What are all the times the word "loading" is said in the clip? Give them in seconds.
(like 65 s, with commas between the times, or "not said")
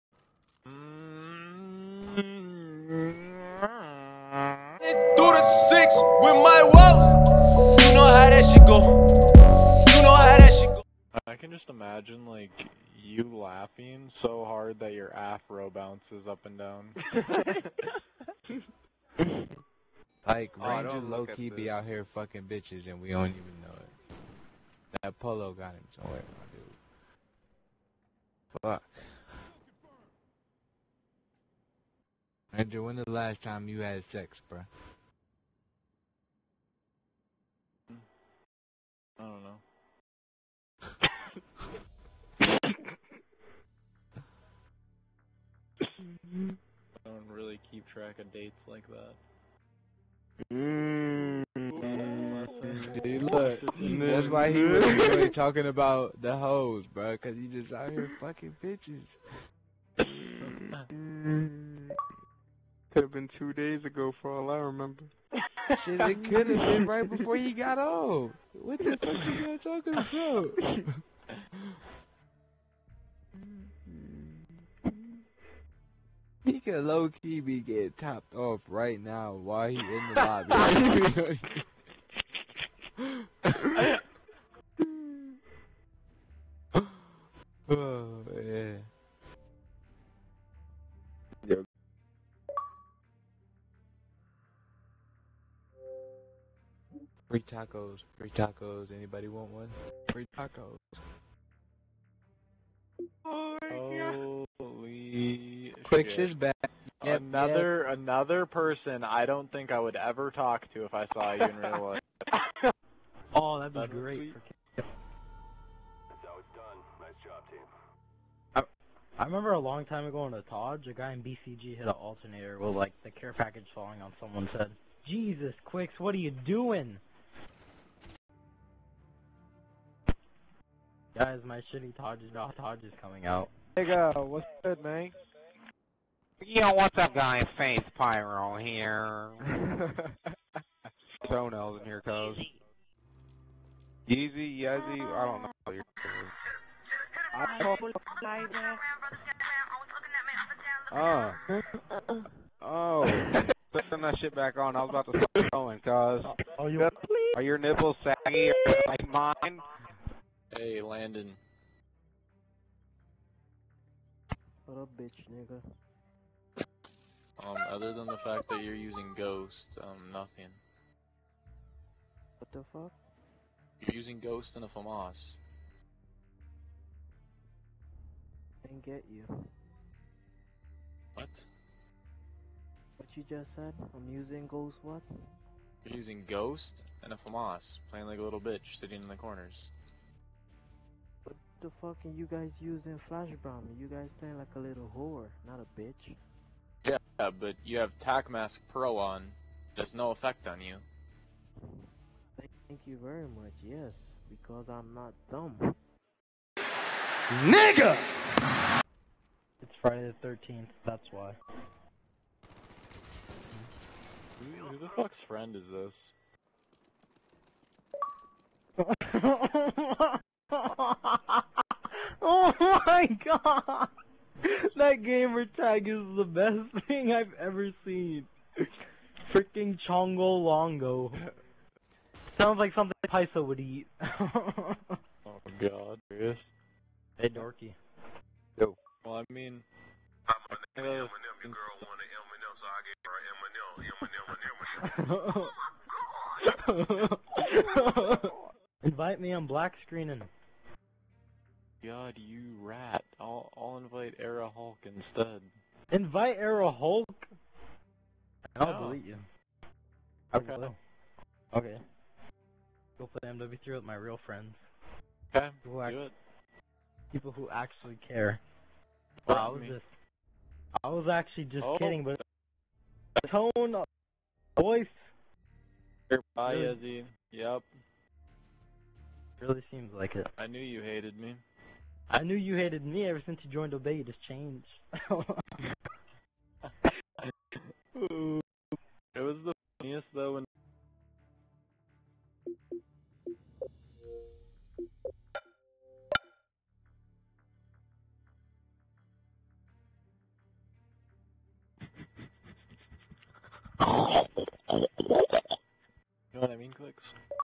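not said.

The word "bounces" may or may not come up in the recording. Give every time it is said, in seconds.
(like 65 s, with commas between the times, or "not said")
15 s.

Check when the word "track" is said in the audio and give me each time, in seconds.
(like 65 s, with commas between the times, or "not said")
47 s.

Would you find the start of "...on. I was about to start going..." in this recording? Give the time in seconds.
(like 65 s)
154 s.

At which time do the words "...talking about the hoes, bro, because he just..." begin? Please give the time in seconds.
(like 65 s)
55 s.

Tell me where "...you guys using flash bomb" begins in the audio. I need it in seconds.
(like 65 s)
192 s.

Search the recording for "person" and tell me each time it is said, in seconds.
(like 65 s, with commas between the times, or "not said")
108 s.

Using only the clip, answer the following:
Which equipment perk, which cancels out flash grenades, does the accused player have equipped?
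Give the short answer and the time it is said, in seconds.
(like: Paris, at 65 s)
Tac Mask Pro, at 197 s.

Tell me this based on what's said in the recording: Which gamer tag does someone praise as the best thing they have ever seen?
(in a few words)
Chongo Longo.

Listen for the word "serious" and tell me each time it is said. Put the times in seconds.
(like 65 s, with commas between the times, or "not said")
236 s.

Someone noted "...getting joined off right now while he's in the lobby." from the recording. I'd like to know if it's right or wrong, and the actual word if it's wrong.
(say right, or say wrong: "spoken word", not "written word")
wrong: "topped", not "joined".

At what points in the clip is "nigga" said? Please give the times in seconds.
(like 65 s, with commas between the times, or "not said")
133 s, 165 s, 207 s.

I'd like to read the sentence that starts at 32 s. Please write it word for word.
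Andrew, when the last time you had sex, bruh?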